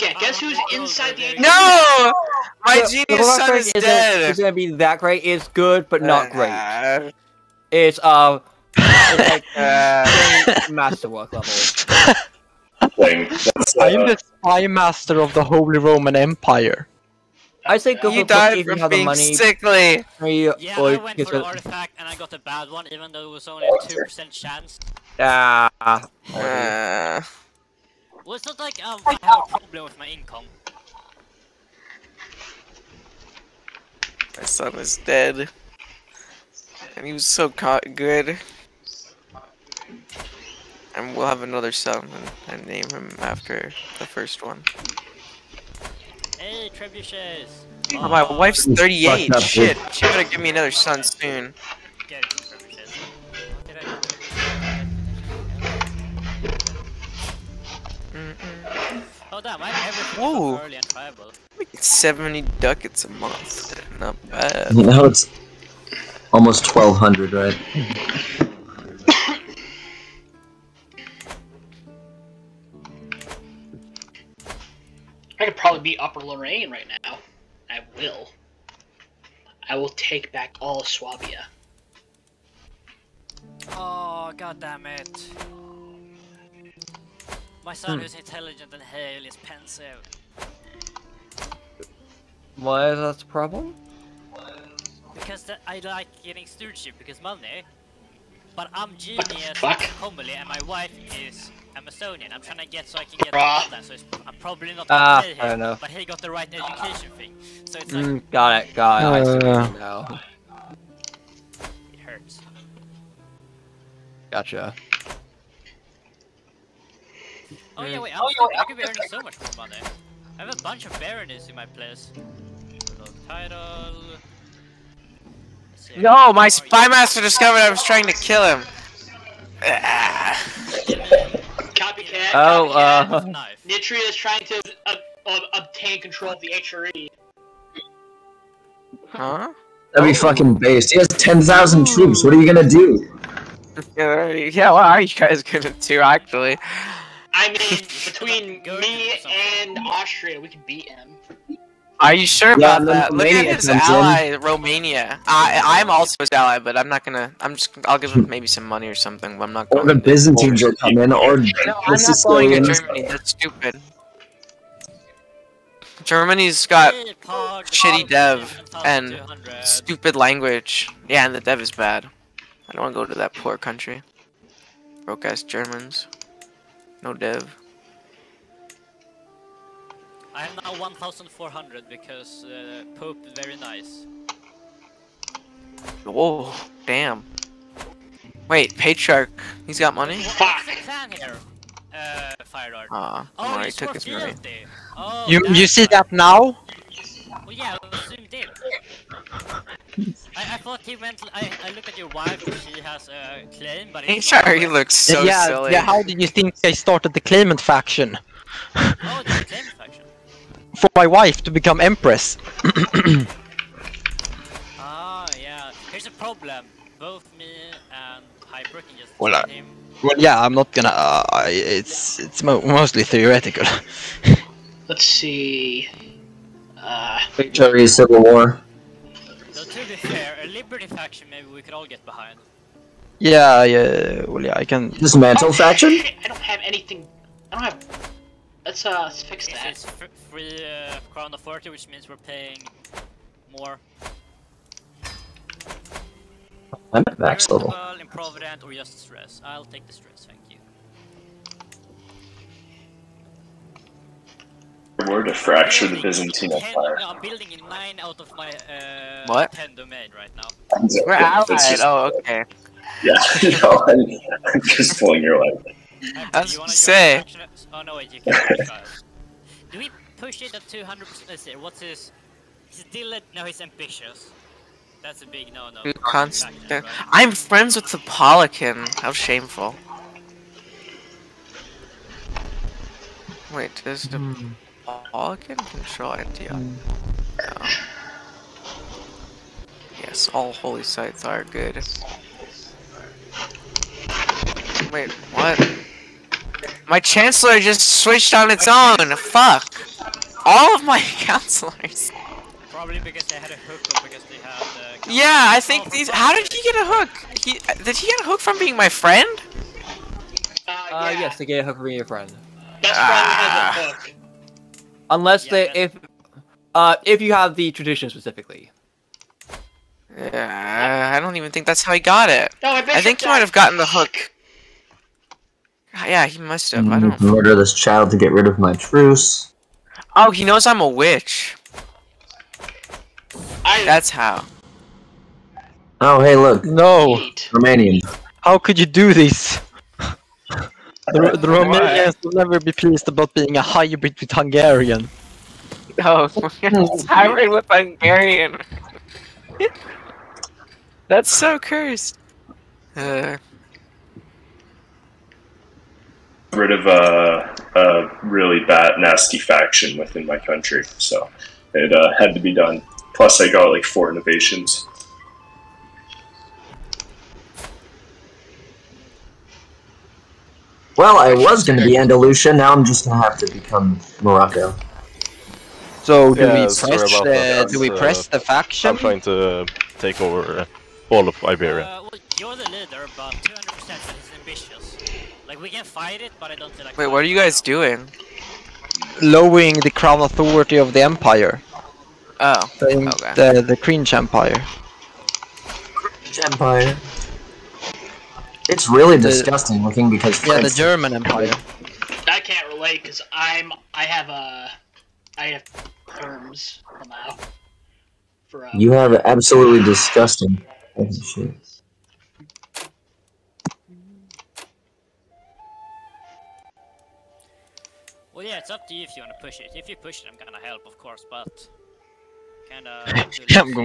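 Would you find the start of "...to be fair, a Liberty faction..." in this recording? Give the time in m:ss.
3:49.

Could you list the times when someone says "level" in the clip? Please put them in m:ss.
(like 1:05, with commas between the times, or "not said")
0:11, 4:07.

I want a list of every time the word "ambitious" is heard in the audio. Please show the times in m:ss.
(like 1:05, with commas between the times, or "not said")
4:33, 6:24.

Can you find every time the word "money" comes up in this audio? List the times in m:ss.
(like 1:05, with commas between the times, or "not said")
0:19, 1:37, 1:59, 2:38, 3:09, 3:14.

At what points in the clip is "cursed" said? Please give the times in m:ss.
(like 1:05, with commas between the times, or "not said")
5:51.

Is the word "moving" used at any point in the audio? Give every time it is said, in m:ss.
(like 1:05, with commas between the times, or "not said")
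not said.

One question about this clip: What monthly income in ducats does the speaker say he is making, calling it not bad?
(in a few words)
70 ducats.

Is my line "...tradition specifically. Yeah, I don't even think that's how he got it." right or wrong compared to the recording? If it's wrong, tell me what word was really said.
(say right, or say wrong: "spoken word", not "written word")
right.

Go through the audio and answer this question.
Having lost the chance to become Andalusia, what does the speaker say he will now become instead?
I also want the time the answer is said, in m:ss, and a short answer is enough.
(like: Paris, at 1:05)
Morocco, at 6:14.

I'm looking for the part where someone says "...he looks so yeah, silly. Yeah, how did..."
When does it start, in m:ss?
3:24.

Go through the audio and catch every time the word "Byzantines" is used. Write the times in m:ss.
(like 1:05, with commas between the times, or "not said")
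2:39, 4:16.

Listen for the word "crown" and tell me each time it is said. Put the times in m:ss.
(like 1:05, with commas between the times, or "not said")
4:01, 6:29.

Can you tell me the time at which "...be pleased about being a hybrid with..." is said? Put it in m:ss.
5:42.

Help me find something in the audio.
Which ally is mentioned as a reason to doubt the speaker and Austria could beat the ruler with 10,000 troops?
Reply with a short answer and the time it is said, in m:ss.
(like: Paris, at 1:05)
Romania, at 2:34.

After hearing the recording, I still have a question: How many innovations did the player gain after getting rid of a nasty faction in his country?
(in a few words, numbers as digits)
4.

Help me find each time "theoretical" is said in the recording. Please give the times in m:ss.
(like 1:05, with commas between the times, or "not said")
3:43.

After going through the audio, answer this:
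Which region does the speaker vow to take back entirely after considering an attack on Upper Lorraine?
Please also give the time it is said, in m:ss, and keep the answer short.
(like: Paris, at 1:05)
Swabia, at 1:20.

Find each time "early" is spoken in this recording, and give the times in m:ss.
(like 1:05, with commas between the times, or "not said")
1:00.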